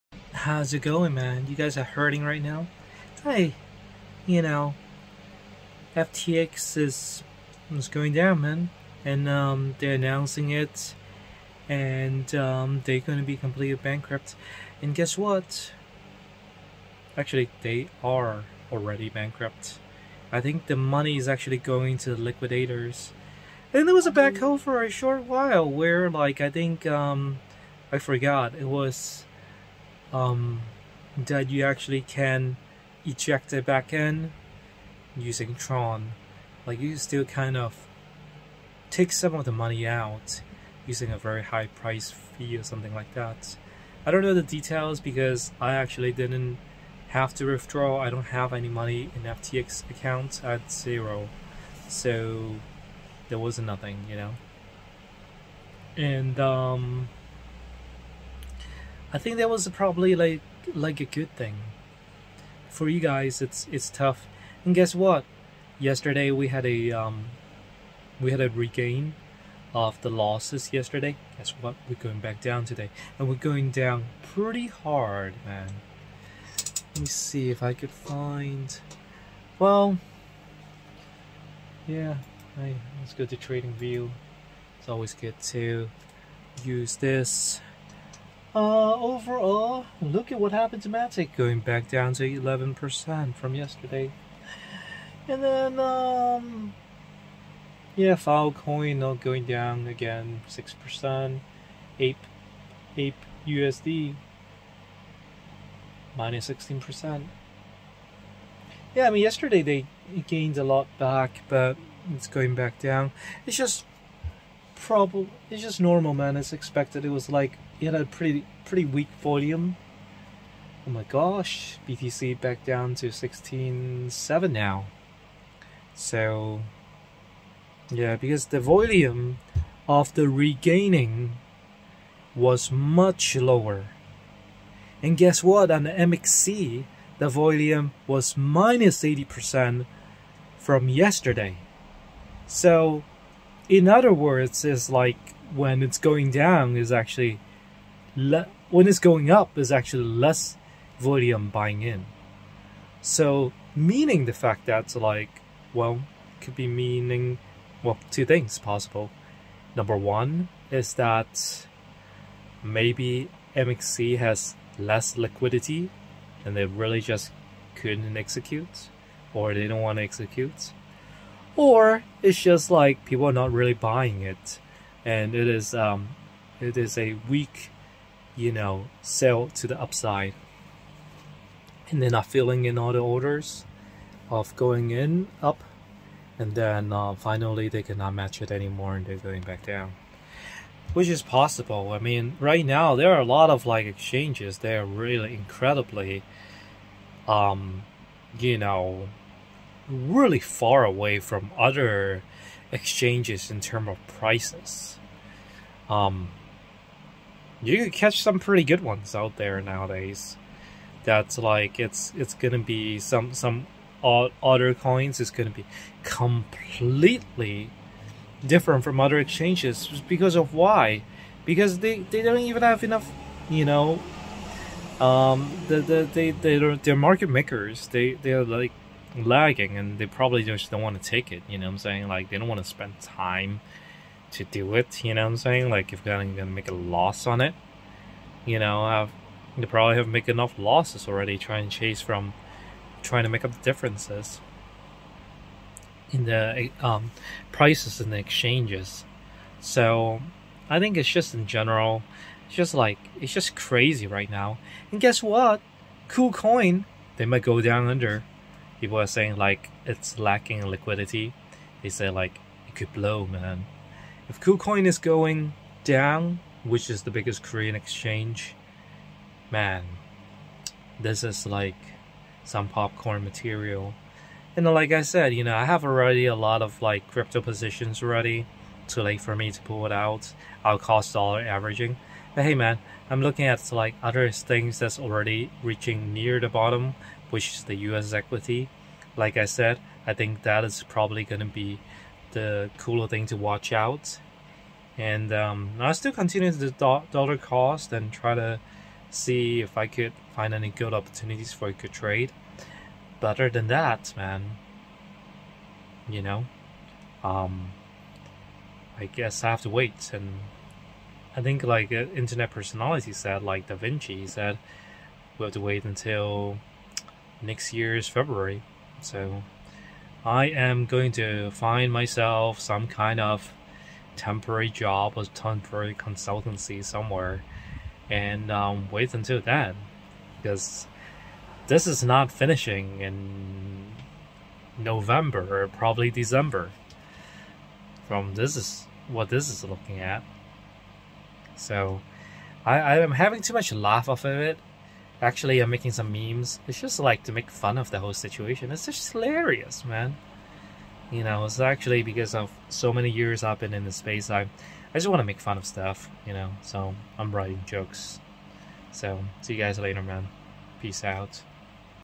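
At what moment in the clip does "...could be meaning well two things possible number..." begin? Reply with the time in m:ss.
2:36.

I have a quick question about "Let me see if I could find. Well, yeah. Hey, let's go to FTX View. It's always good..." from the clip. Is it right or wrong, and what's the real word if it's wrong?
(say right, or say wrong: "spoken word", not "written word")
wrong: "Trading", not "FTX".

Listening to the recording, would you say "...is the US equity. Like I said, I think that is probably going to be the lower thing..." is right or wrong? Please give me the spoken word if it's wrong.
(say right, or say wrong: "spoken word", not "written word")
wrong: "cooler", not "lower".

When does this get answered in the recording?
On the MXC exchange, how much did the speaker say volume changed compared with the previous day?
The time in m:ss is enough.
2:18.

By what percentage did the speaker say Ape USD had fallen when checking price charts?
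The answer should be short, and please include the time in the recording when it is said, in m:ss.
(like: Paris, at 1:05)
16%, at 1:46.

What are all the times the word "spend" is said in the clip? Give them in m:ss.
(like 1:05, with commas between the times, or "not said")
3:52.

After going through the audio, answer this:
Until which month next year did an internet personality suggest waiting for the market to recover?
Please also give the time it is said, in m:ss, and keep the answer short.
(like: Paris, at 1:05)
February, at 5:18.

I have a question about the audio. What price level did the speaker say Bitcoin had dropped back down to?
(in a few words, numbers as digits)
16.7.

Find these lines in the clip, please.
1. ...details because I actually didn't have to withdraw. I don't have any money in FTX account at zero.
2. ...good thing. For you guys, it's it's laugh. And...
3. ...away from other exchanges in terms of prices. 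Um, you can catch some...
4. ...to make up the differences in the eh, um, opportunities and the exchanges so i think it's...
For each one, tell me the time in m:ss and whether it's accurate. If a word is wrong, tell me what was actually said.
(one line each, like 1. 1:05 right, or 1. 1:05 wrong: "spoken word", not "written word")
1. 0:44 right
2. 1:01 wrong: "tough", not "laugh"
3. 3:20 right
4. 4:03 wrong: "prices", not "opportunities".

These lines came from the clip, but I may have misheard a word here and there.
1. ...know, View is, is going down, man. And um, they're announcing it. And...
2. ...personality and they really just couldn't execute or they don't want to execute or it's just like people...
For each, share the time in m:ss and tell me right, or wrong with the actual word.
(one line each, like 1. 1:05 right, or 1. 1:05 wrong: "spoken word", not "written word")
1. 0:04 wrong: "FTX", not "View"
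2. 2:45 wrong: "liquidity", not "personality".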